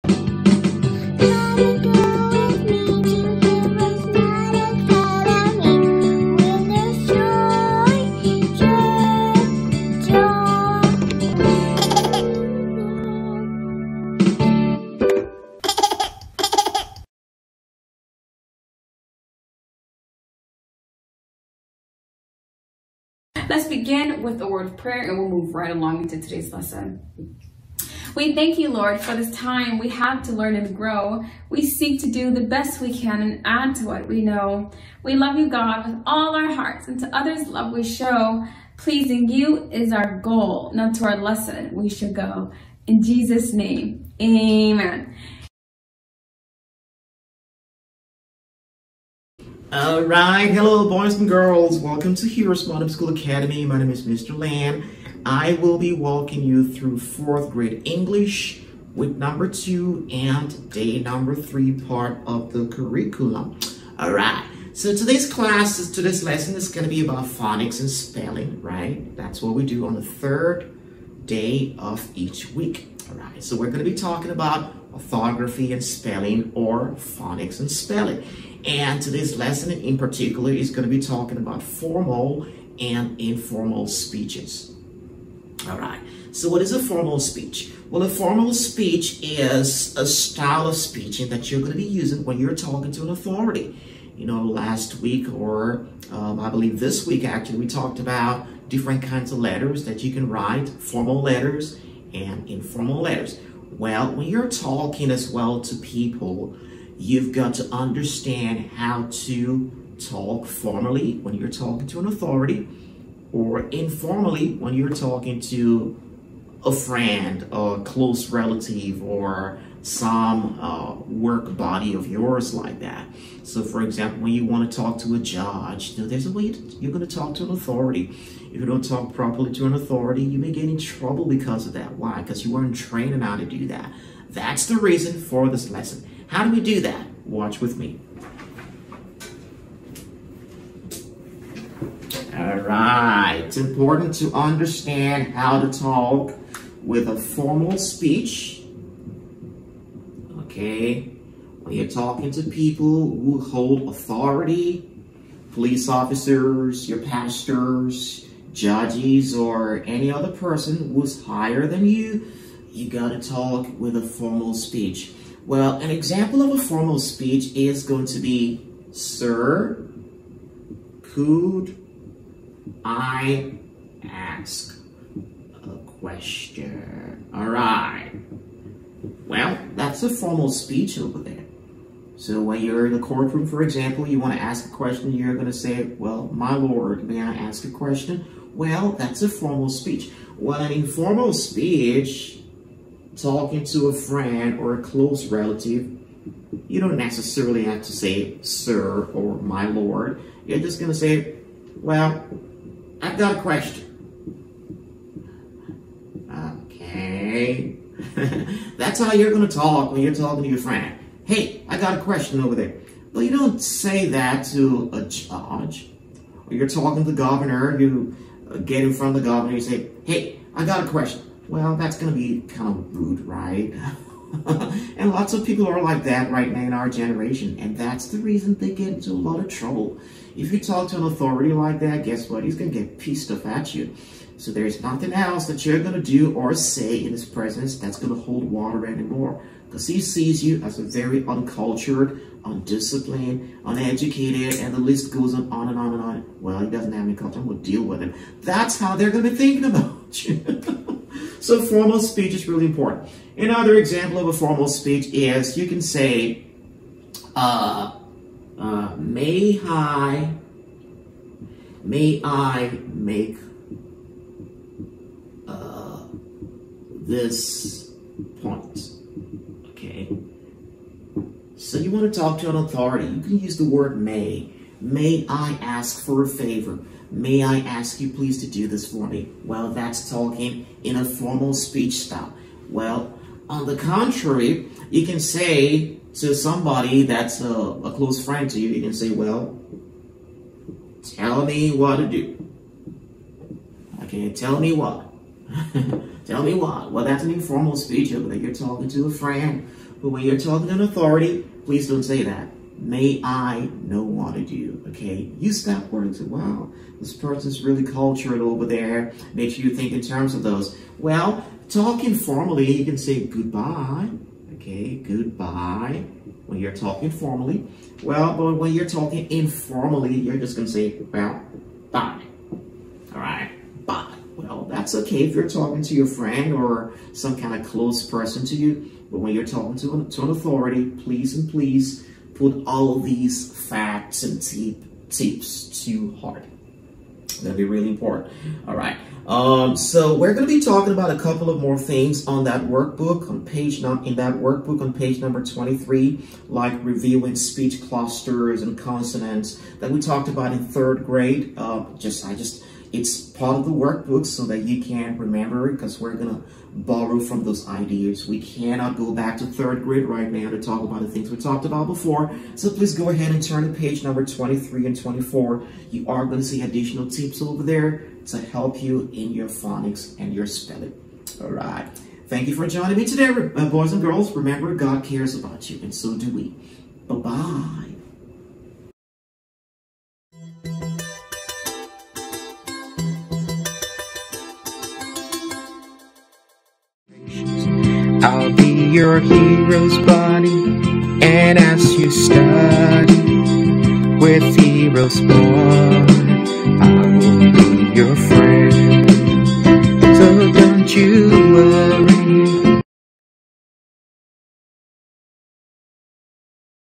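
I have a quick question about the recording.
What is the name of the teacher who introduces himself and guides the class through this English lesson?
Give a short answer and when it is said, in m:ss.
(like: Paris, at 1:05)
Mr. Lam, at 0:54.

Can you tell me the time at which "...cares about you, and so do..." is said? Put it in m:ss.
6:15.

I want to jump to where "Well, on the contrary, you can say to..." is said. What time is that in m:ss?
4:42.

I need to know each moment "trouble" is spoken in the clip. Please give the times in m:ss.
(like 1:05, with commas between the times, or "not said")
2:10, 3:49.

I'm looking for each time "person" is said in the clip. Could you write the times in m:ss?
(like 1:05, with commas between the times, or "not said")
2:40, 5:07, 5:28.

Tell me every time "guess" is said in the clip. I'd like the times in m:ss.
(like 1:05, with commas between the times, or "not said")
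3:52.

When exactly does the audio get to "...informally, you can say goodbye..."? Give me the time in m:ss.
5:12.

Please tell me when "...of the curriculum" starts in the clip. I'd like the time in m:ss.
1:02.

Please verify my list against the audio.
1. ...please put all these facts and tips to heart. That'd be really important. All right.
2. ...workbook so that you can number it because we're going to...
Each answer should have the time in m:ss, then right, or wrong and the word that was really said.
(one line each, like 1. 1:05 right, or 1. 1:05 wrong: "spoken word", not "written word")
1. 5:31 right
2. 5:53 wrong: "remember", not "number".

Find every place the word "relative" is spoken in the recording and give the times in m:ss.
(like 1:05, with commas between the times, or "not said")
1:58, 3:15.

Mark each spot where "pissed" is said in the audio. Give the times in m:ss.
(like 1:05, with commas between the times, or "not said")
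3:52.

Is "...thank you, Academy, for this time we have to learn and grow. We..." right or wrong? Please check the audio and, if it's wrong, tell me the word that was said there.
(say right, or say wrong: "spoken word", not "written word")
wrong: "Lord", not "Academy".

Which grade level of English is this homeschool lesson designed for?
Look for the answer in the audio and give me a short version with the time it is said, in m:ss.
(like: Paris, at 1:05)
4th grade, at 0:56.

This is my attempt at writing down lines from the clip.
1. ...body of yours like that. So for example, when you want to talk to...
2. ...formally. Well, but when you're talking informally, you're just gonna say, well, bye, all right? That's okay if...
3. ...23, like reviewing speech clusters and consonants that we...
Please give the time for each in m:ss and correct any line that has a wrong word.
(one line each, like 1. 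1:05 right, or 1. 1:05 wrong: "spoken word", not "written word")
1. 2:01 right
2. 5:17 right
3. 5:45 right.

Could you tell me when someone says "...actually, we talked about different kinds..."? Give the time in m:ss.
1:37.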